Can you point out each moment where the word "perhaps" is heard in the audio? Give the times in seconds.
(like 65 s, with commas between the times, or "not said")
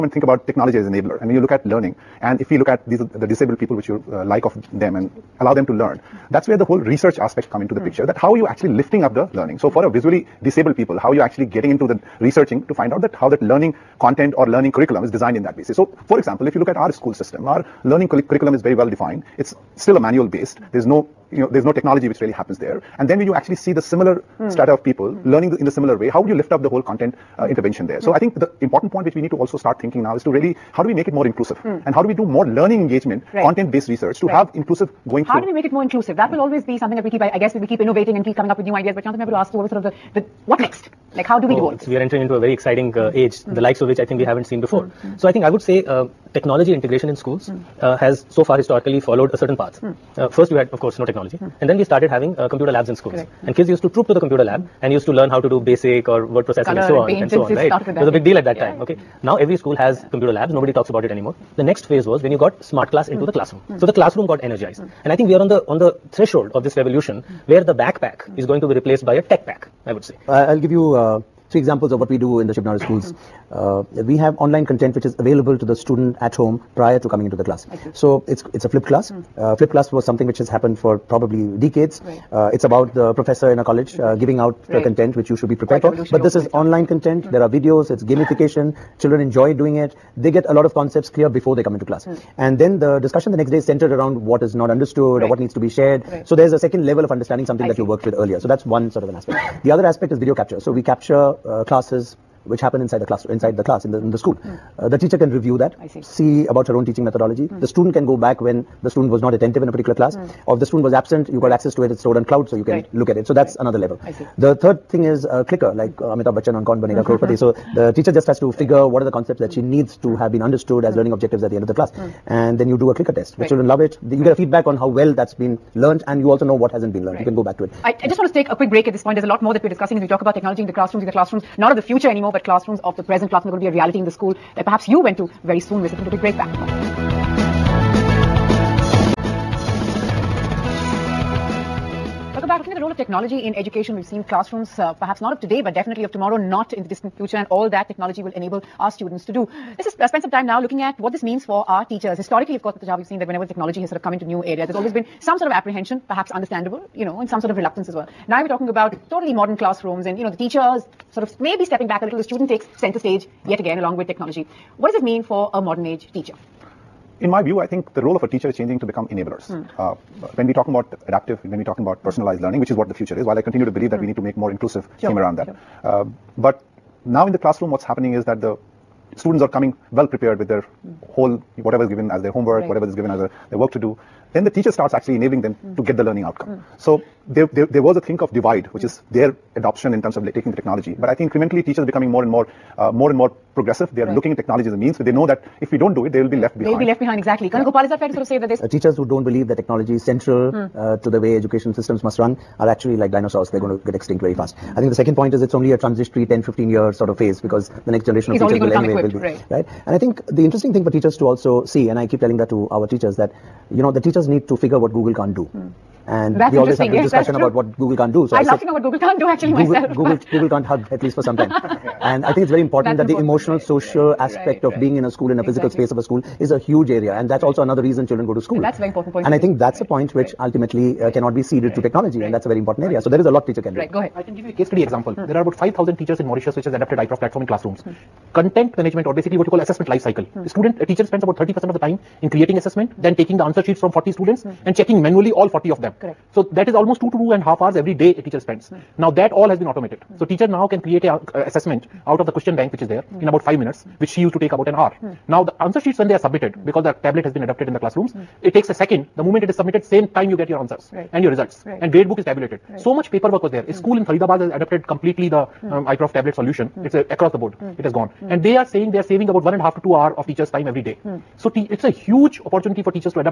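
134 s, 145 s, 156 s.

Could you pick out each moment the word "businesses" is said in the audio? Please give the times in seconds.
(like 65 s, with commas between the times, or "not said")
not said.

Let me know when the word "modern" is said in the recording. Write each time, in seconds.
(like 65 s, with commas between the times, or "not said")
159 s, 165 s.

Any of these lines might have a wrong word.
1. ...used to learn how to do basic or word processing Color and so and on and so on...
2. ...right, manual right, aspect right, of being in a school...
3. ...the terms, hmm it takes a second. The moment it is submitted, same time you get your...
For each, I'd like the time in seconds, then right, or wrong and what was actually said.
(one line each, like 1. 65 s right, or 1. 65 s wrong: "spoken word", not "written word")
1. 54 s right
2. 223 s wrong: "social", not "manual"
3. 257 s wrong: "classrooms", not "terms".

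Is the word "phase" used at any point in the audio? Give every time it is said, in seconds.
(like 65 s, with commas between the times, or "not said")
61 s, 207 s.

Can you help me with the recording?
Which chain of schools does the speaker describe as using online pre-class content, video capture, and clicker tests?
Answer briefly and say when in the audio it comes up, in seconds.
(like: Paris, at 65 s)
Shiv Nadar schools, at 72 s.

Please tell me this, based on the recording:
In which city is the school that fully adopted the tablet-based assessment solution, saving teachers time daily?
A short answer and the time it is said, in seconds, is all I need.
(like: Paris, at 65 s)
Faridabad, at 264 s.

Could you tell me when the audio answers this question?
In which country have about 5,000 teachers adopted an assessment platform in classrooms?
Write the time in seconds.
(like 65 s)
236 s.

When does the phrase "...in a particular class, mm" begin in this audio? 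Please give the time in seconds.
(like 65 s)
109 s.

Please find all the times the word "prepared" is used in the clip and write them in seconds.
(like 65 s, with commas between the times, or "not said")
85 s, 180 s.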